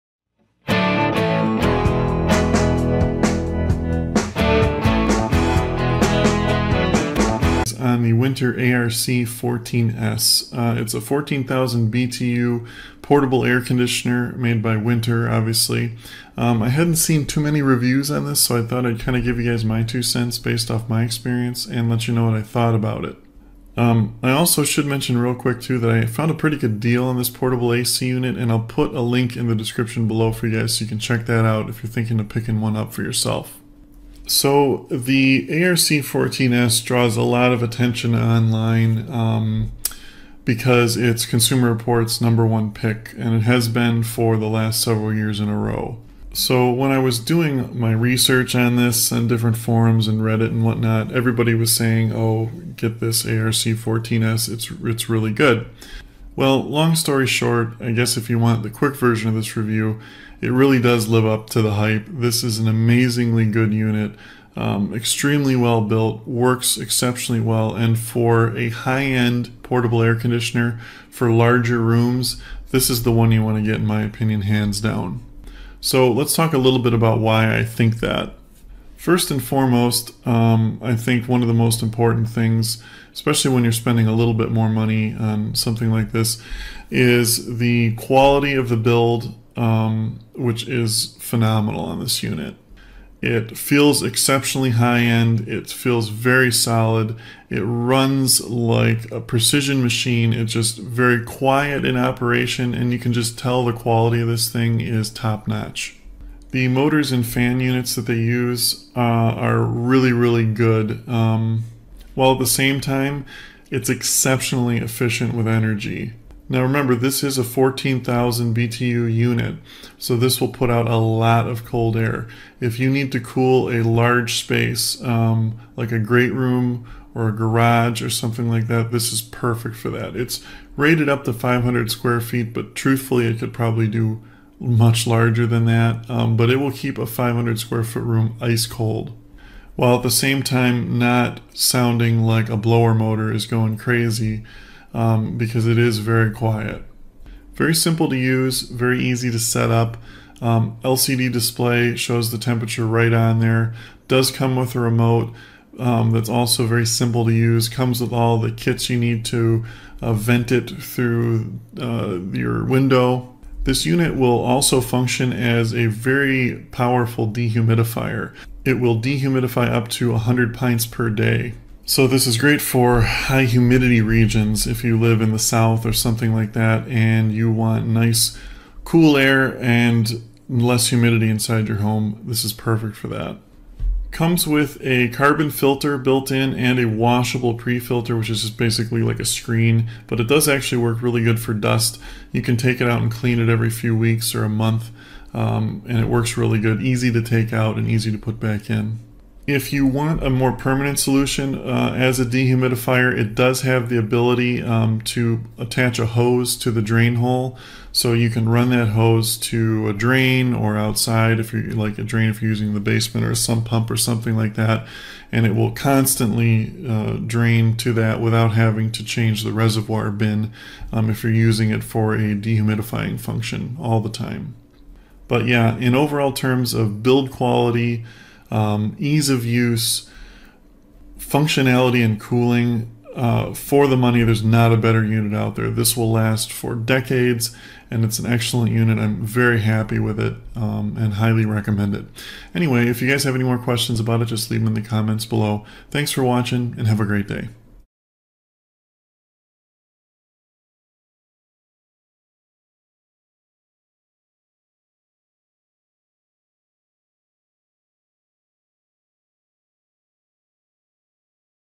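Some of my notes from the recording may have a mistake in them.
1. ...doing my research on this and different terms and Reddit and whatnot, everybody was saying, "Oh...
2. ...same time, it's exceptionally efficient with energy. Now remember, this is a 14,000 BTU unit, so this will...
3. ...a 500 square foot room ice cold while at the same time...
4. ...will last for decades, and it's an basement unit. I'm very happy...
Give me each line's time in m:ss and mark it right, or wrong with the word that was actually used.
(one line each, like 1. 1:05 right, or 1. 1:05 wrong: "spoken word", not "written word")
1. 0:47 wrong: "forums", not "terms"
2. 1:52 right
3. 2:16 right
4. 3:55 wrong: "excellent", not "basement".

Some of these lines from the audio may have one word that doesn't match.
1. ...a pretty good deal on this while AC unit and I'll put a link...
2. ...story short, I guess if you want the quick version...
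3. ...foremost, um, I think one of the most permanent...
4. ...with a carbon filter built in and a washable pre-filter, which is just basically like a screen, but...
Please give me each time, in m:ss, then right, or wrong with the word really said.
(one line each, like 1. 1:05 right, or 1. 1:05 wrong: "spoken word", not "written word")
1. 0:26 wrong: "portable", not "while"
2. 0:56 right
3. 1:19 wrong: "important", not "permanent"
4. 3:04 right.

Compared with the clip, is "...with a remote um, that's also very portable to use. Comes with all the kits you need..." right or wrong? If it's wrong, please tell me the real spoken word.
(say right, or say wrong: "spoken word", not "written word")
wrong: "simple", not "portable".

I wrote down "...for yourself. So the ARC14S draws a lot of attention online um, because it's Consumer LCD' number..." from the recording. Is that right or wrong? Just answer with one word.
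wrong.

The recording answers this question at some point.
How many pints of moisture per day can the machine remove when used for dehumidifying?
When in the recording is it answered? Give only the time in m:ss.
2:50.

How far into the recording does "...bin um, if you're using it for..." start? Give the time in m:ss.
3:40.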